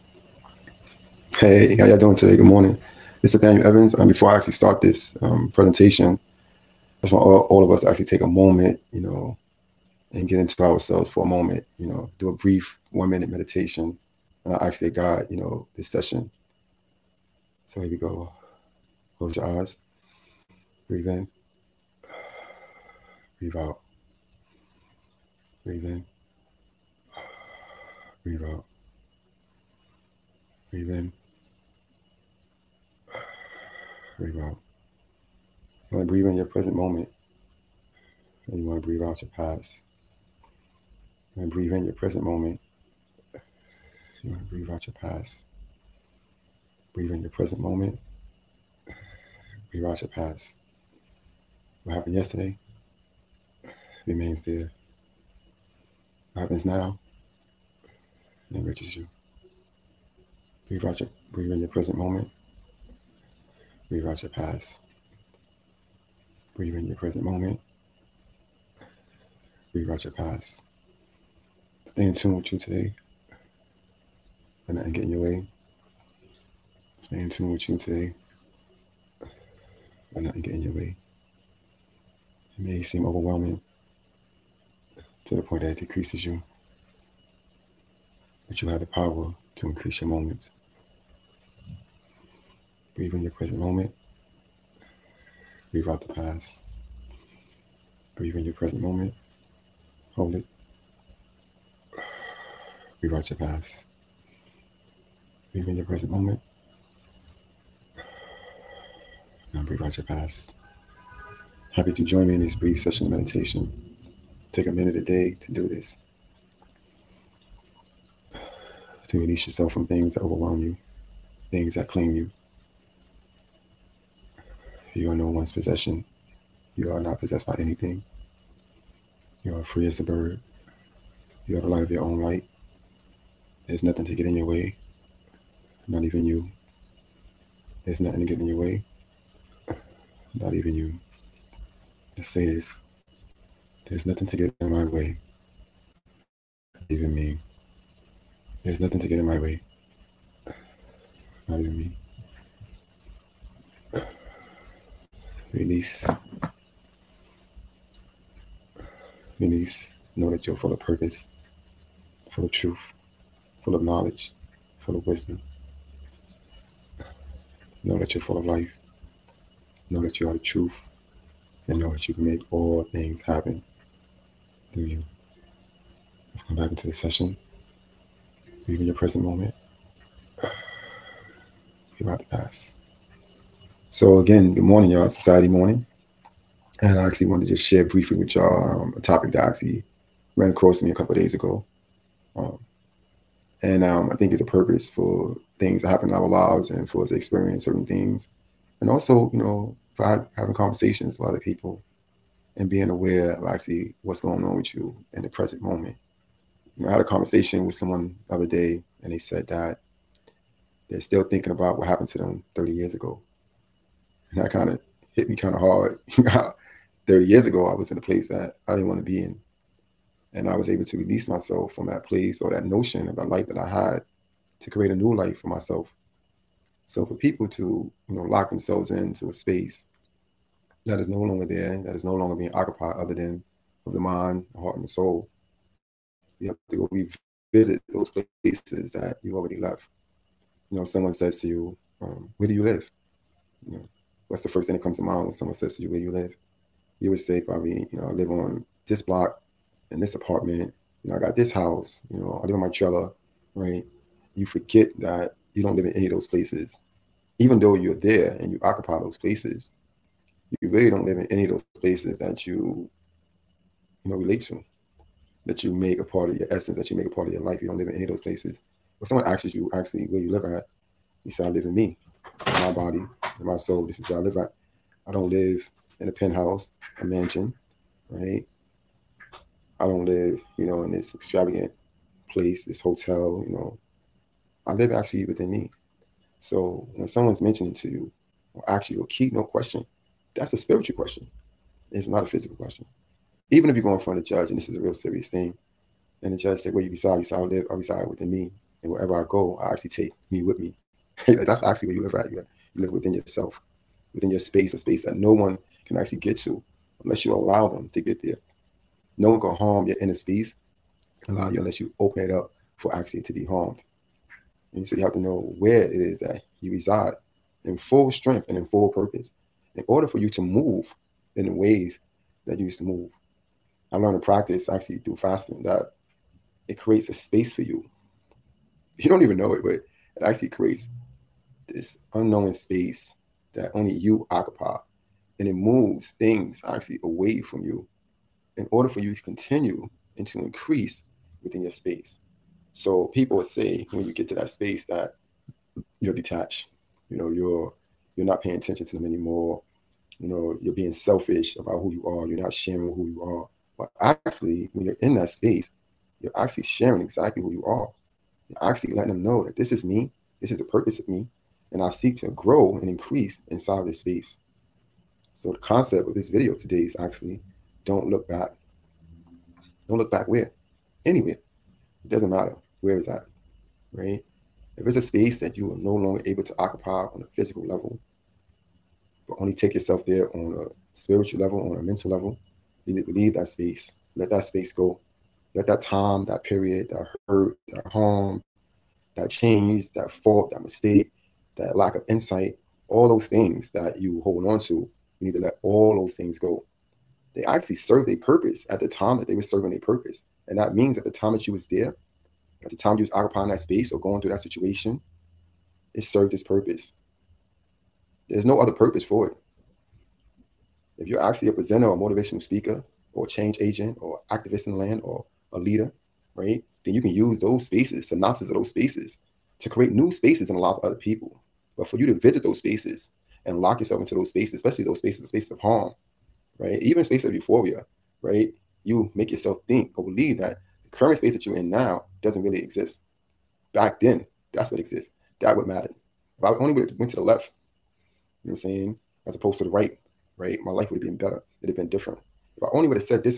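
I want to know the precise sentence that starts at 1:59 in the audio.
To release yourself from things that overwhelm you, things that claim you.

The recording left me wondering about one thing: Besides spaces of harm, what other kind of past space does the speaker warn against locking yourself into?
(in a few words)
euphoria.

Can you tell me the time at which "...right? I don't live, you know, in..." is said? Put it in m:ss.
4:38.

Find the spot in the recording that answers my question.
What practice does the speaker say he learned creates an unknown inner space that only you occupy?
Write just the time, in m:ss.
5:25.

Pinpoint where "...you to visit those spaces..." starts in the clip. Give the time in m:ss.
7:01.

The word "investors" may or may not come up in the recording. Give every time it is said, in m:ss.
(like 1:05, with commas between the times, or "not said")
not said.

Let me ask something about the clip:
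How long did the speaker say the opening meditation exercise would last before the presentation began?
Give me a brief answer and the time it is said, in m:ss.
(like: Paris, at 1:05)
1 minute, at 0:12.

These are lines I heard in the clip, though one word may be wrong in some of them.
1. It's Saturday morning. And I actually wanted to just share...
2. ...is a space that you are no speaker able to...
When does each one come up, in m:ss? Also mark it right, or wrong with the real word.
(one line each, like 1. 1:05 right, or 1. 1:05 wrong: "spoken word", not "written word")
1. 3:05 right
2. 6:14 wrong: "longer", not "speaker".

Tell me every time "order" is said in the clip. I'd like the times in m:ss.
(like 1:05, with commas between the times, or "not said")
5:19, 5:38.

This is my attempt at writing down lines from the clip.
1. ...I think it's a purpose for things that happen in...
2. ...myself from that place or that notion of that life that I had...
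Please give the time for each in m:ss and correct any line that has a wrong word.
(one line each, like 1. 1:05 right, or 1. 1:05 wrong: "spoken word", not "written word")
1. 3:14 right
2. 3:41 right.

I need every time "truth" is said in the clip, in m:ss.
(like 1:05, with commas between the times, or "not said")
2:42, 2:50.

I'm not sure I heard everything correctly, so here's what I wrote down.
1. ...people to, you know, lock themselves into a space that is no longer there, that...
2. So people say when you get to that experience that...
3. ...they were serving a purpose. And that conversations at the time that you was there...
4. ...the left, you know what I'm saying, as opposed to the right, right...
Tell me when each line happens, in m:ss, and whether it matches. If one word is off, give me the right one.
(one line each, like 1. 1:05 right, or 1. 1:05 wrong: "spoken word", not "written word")
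1. 3:47 right
2. 5:42 wrong: "space", not "experience"
3. 6:39 wrong: "means", not "conversations"
4. 7:17 right.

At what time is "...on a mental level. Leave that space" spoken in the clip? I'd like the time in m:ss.
6:21.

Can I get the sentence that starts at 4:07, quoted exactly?
You would say probably, you know, I live on this block in this apartment.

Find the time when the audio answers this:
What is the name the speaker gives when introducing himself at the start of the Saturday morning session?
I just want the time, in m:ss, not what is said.
0:03.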